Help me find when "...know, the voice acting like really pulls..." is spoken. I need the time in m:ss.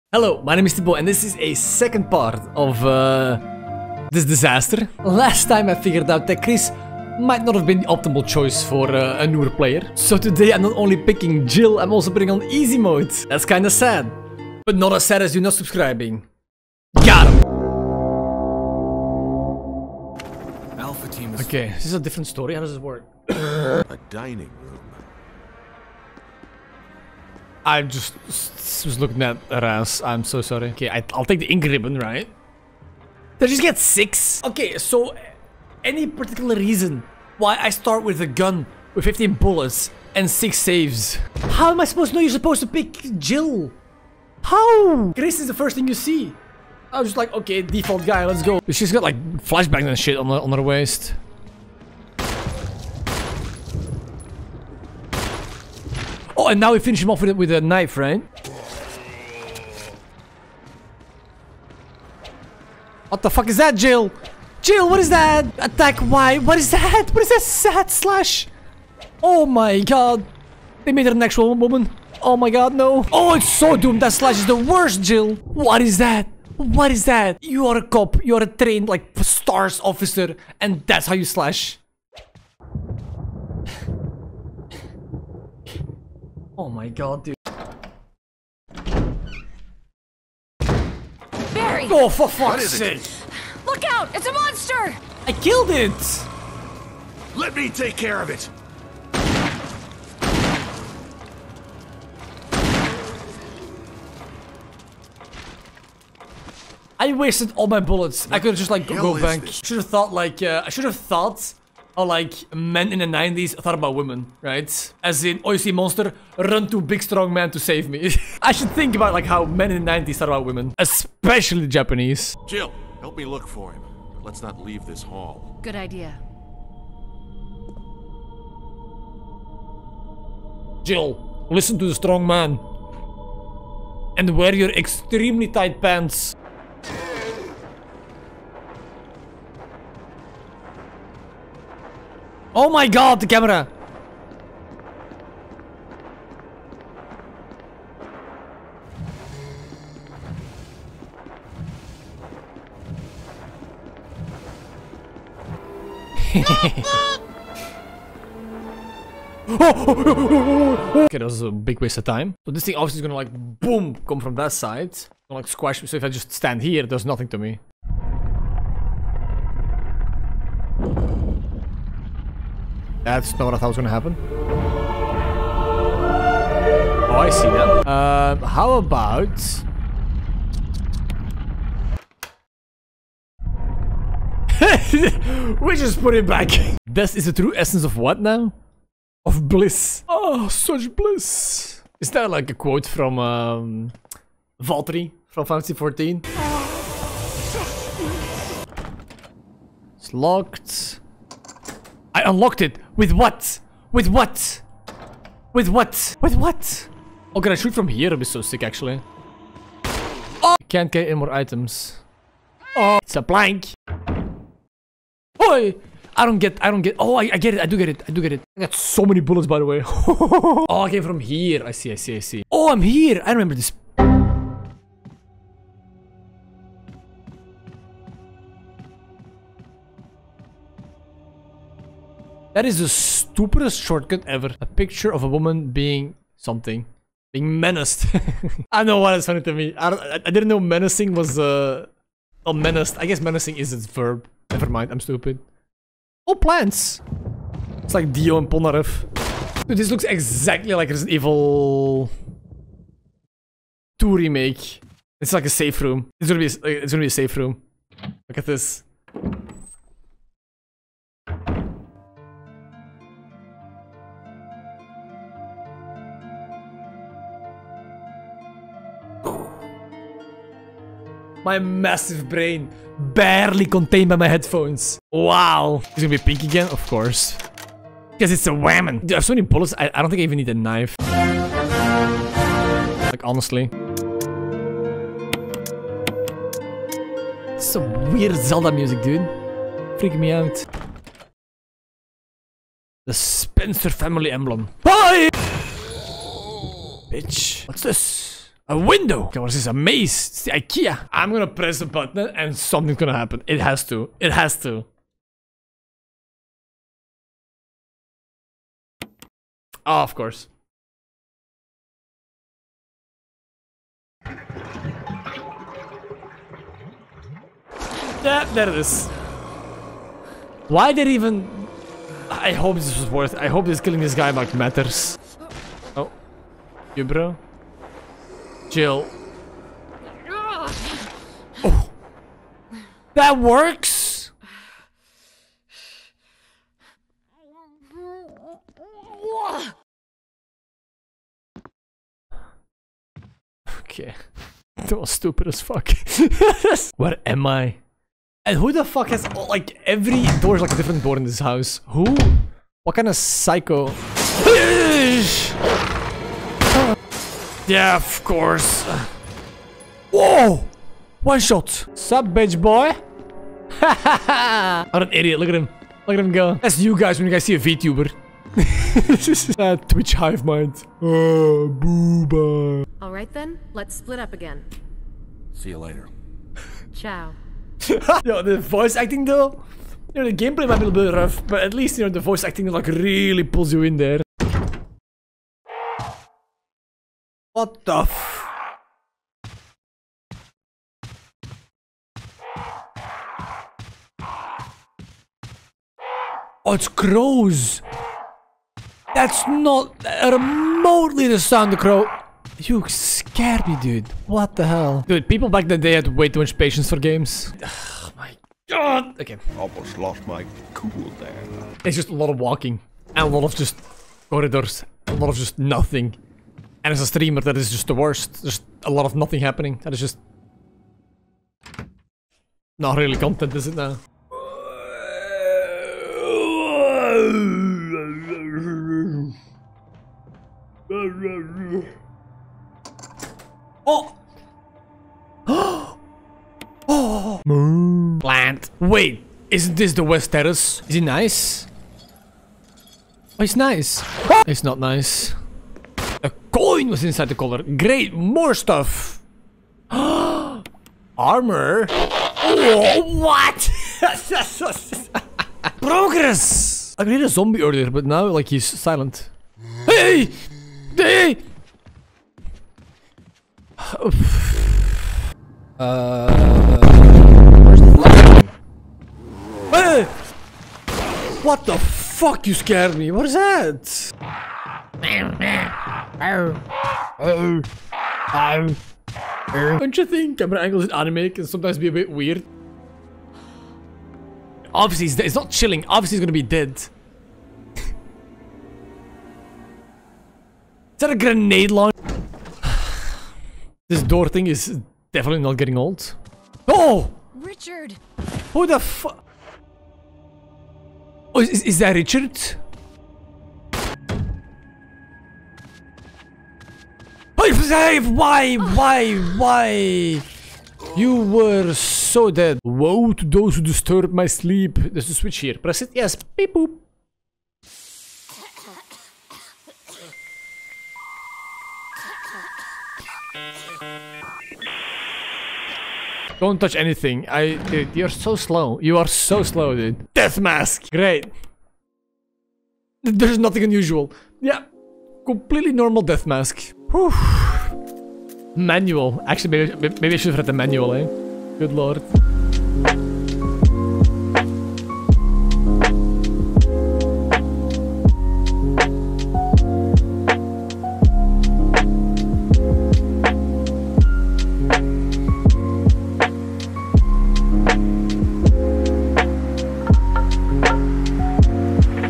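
6:22.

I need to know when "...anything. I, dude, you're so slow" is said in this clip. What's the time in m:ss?
8:46.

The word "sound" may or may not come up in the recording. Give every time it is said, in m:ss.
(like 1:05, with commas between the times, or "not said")
6:41.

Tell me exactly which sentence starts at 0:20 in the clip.
Alpha team is okay, this is a different story.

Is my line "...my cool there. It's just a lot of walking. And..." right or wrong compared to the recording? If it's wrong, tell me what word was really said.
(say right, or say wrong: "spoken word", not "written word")
right.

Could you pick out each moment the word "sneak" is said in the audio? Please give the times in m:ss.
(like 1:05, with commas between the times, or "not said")
not said.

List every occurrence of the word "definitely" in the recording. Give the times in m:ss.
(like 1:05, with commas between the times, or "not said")
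8:15.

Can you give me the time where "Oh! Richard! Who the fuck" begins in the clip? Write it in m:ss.
8:16.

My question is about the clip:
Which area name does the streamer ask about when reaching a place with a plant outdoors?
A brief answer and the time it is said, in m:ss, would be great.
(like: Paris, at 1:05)
West Terrace, at 7:20.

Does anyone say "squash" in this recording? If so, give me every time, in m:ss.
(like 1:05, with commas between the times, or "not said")
2:45.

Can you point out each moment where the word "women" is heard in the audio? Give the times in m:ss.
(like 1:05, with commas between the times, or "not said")
1:53, 2:00.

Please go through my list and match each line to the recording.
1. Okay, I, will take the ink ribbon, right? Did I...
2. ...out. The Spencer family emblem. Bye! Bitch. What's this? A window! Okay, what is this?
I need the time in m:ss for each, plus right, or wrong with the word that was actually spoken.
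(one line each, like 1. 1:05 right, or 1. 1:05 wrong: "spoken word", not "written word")
1. 0:30 right
2. 4:50 right.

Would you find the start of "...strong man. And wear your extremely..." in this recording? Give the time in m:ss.
2:11.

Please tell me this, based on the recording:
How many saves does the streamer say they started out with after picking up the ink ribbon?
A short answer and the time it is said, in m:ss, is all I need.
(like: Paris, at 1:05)
6, at 0:40.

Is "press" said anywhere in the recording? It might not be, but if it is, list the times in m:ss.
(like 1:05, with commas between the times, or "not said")
5:01, 8:35.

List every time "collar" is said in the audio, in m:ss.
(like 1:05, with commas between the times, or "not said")
7:27.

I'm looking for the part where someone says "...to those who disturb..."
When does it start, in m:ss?
8:33.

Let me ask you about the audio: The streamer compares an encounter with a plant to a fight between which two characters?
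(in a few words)
Dio and Polnareff.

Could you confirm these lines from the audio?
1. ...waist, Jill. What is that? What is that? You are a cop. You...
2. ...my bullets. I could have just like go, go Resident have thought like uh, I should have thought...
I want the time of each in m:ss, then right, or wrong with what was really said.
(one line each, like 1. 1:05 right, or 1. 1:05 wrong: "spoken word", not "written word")
1. 1:14 wrong: "worst", not "waist"
2. 1:47 wrong: "Should", not "Resident".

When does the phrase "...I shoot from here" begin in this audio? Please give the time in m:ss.
3:27.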